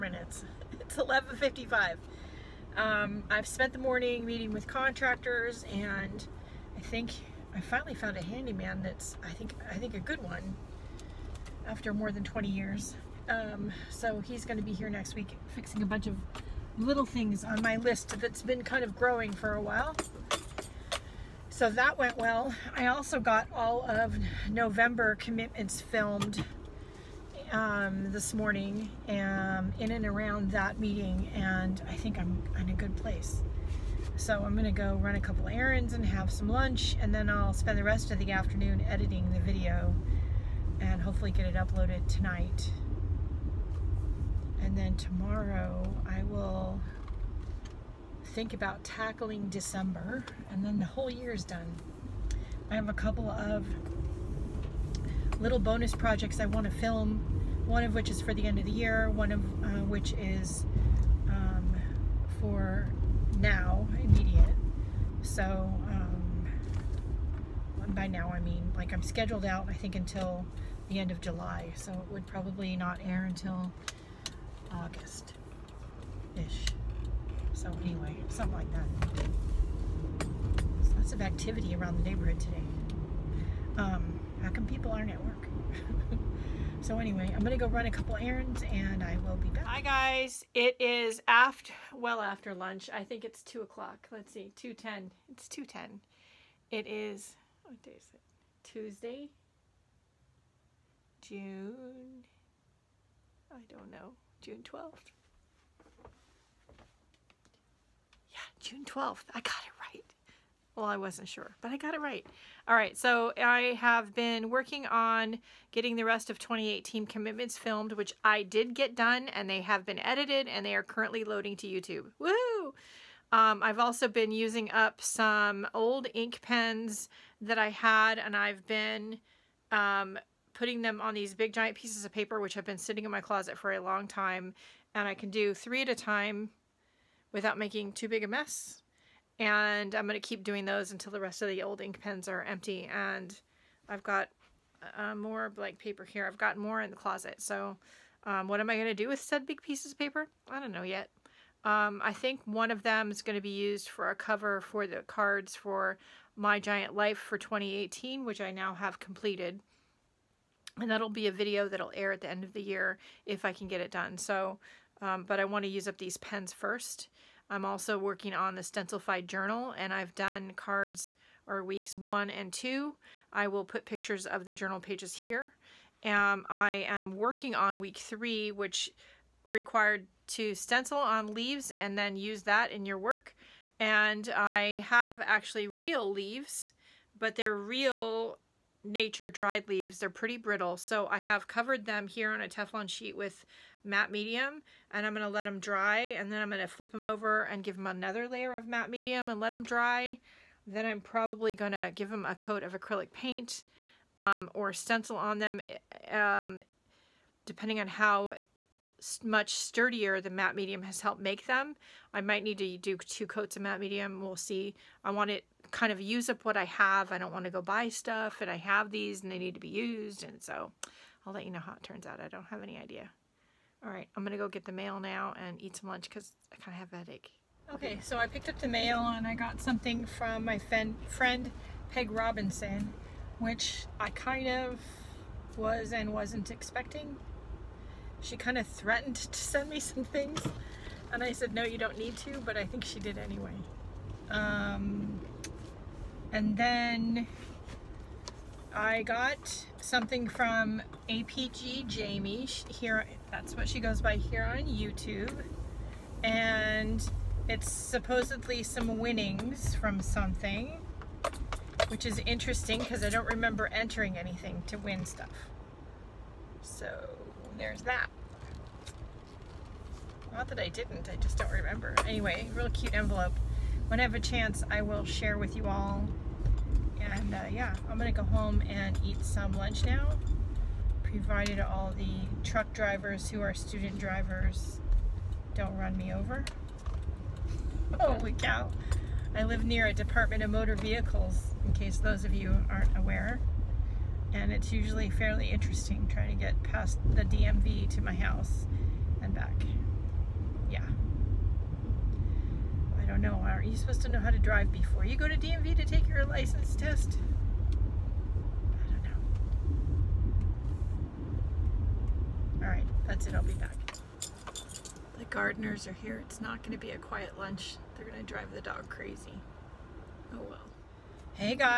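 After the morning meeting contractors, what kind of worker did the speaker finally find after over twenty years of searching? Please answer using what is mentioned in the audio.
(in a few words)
handyman.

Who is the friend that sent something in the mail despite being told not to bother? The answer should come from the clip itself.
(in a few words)
Peg Robinson.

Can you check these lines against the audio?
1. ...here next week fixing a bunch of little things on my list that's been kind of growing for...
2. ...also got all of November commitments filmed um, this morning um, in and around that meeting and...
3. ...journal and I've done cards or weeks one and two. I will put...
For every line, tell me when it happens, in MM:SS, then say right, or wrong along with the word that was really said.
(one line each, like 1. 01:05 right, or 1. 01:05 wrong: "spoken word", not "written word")
1. 00:14 right
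2. 00:22 right
3. 02:49 right.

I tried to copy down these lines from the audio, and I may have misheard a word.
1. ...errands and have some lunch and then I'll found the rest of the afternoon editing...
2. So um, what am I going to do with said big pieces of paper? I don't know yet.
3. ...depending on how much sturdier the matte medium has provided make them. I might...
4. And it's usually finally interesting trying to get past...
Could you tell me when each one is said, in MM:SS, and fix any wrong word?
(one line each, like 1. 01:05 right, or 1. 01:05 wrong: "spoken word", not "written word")
1. 00:35 wrong: "spend", not "found"
2. 02:27 right
3. 03:27 wrong: "helped", not "provided"
4. 04:54 wrong: "fairly", not "finally".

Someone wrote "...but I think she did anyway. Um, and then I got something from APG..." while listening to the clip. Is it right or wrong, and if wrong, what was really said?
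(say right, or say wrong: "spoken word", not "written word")
right.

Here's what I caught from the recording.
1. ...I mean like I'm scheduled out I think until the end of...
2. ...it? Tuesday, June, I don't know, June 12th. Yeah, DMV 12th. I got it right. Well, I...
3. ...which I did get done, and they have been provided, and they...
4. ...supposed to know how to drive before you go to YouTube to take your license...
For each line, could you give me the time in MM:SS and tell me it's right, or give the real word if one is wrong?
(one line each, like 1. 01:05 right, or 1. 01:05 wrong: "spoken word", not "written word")
1. 01:08 right
2. 01:38 wrong: "June", not "DMV"
3. 01:57 wrong: "edited", not "provided"
4. 05:03 wrong: "DMV", not "YouTube".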